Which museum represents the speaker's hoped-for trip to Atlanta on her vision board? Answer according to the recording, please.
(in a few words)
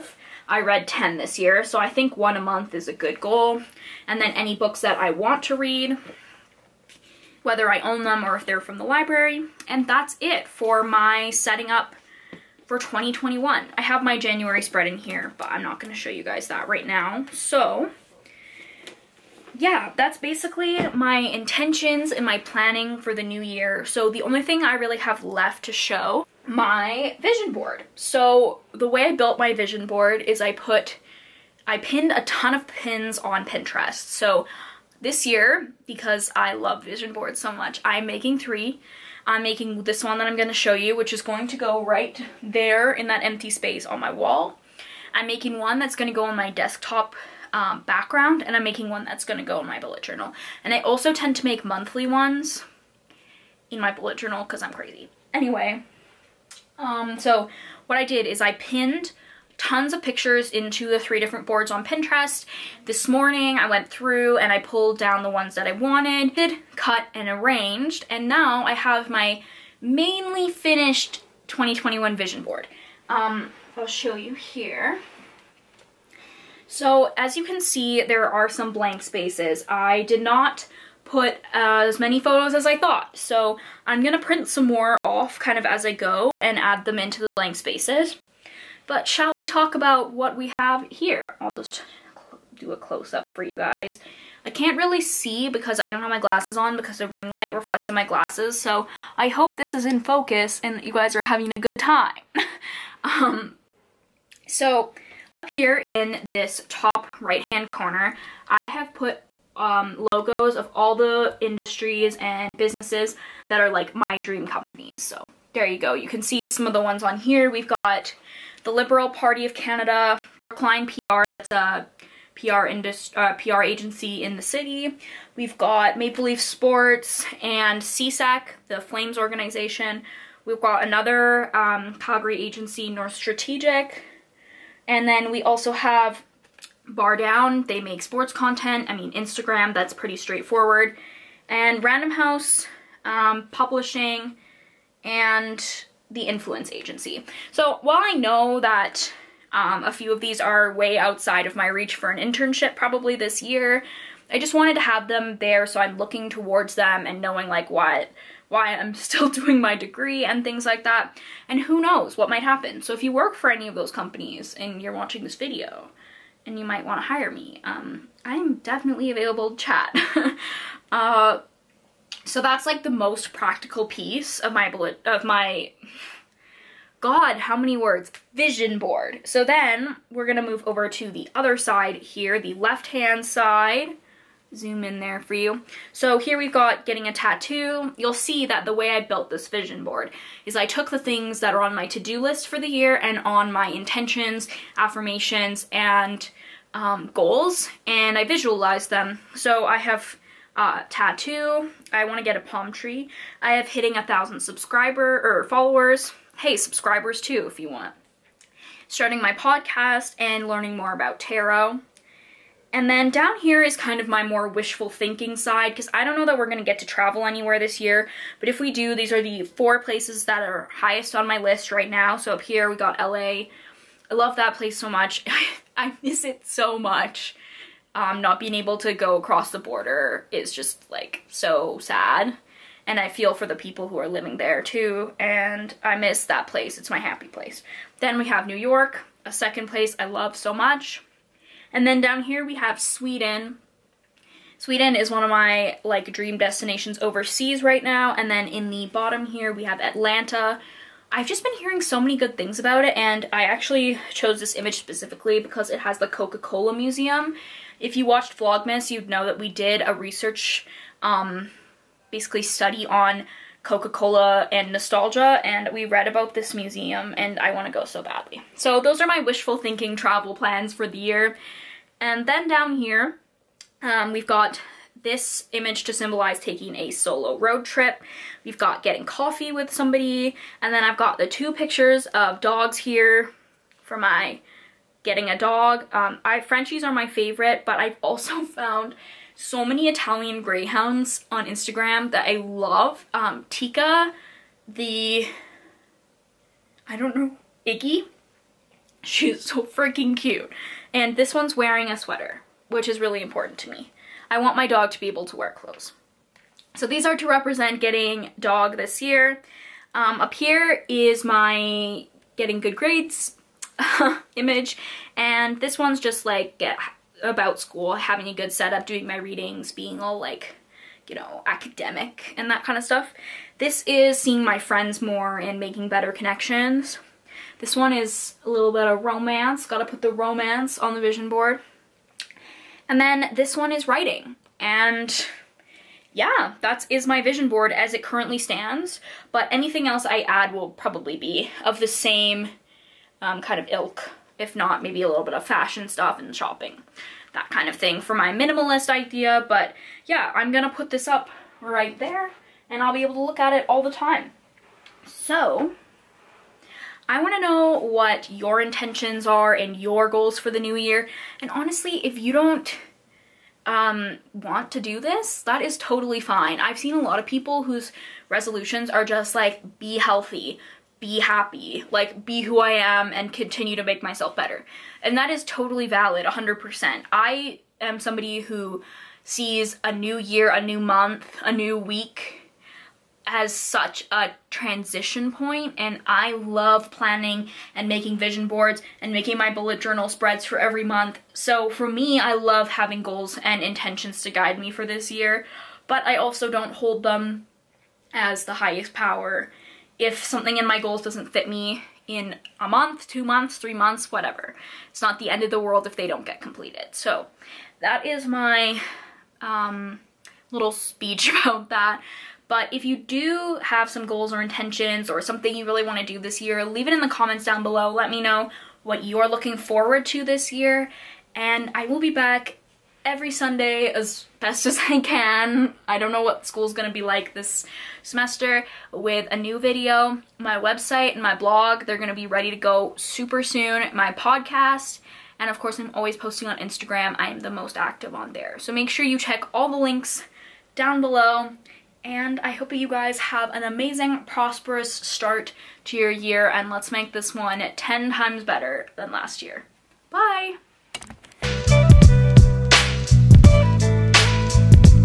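Coca-Cola Museum.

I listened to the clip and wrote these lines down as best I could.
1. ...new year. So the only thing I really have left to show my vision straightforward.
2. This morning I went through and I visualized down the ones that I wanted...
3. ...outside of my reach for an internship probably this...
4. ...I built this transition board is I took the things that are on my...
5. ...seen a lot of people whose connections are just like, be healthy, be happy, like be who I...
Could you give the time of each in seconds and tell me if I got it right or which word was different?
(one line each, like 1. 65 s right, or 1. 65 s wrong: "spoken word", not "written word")
1. 23 s wrong: "board", not "straightforward"
2. 62 s wrong: "pulled", not "visualized"
3. 150 s right
4. 188 s wrong: "vision", not "transition"
5. 366 s wrong: "resolutions", not "connections".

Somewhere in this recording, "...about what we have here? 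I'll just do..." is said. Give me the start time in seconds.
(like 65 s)
89 s.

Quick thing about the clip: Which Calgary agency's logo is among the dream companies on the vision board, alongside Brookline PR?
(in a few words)
North Strategic.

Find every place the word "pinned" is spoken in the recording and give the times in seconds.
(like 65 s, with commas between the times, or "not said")
31 s, 58 s.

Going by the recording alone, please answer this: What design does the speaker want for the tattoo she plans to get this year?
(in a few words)
palm tree.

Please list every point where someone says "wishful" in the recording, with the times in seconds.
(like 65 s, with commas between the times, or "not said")
214 s, 269 s.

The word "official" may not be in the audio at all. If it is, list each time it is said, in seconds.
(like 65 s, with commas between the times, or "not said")
not said.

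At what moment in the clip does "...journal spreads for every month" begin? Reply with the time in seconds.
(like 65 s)
389 s.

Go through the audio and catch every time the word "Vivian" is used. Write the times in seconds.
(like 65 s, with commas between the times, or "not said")
not said.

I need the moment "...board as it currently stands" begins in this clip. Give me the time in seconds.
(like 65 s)
337 s.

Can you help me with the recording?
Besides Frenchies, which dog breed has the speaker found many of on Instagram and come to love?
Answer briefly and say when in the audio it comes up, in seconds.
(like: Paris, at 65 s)
Italian greyhounds, at 289 s.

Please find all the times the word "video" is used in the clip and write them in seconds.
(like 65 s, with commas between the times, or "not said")
165 s, 429 s.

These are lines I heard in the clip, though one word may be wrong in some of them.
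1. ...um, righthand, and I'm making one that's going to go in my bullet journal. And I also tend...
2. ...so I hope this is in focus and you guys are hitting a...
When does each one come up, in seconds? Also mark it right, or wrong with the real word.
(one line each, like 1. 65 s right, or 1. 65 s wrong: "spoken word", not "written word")
1. 47 s wrong: "background", not "righthand"
2. 98 s wrong: "having", not "hitting".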